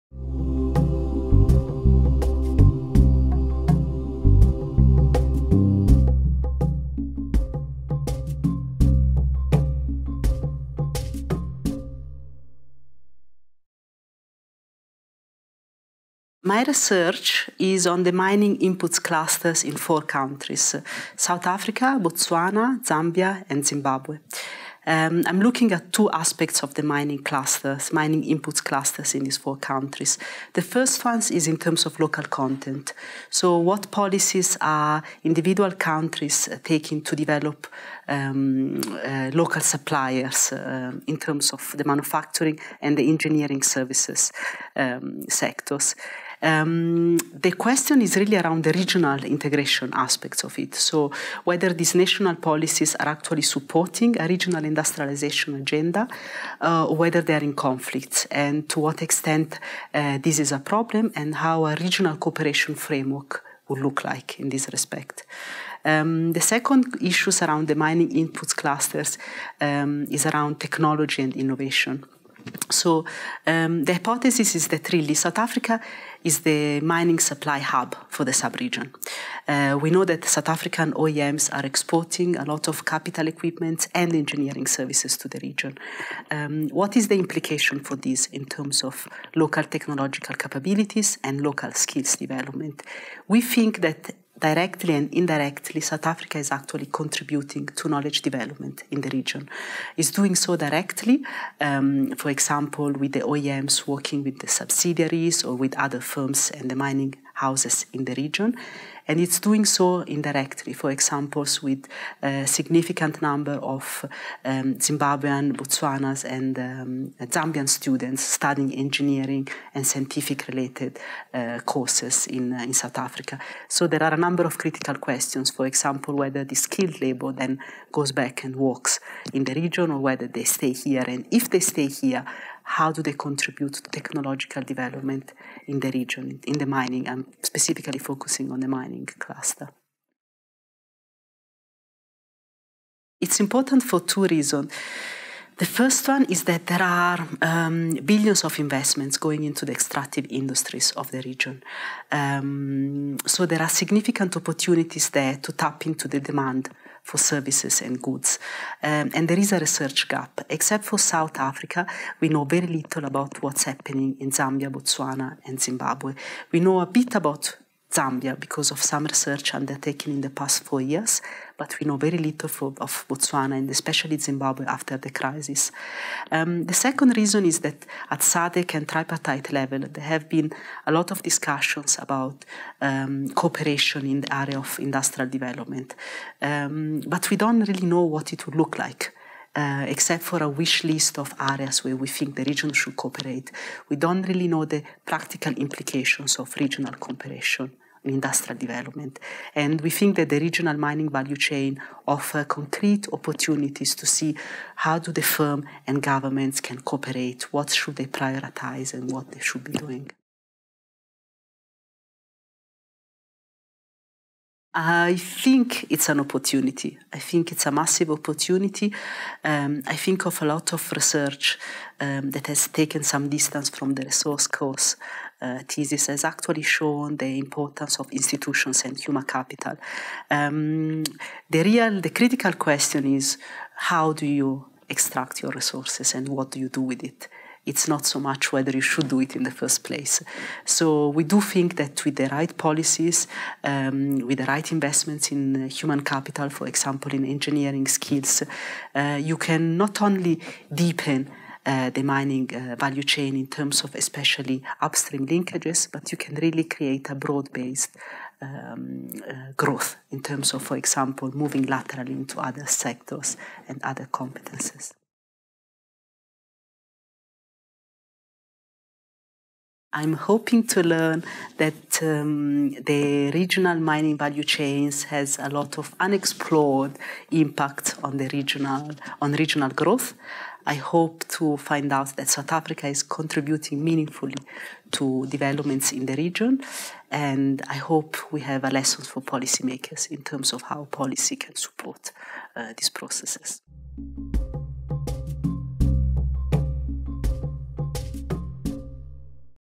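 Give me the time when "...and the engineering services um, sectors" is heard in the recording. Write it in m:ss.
0:42.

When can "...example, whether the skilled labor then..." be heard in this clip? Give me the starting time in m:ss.
2:05.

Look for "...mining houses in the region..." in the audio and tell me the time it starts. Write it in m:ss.
1:46.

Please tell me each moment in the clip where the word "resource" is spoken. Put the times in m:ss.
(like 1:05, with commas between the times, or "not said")
3:44, 3:55.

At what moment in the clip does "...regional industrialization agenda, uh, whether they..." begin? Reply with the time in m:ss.
0:54.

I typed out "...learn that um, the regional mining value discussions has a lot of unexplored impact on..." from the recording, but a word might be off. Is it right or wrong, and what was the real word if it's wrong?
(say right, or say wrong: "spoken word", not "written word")
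wrong: "chains", not "discussions".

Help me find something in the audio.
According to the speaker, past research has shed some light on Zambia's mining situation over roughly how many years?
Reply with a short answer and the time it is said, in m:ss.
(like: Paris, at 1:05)
4 years, at 2:50.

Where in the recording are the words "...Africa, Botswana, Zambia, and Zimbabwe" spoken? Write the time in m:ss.
0:21.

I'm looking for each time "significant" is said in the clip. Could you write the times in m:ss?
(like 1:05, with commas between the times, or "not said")
1:52, 2:33.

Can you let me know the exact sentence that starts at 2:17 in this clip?
I'm specifically focusing on the mining cluster.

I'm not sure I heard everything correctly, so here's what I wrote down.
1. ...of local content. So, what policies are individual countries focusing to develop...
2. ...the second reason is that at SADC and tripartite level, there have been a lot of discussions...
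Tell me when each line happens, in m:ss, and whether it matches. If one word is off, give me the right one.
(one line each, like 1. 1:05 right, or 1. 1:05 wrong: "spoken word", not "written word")
1. 0:31 wrong: "taking", not "focusing"
2. 2:56 right.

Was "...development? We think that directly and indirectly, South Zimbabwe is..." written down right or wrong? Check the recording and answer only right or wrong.
wrong.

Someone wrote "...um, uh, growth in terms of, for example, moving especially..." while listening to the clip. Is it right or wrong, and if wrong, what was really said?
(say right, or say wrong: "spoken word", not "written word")
wrong: "laterally", not "especially".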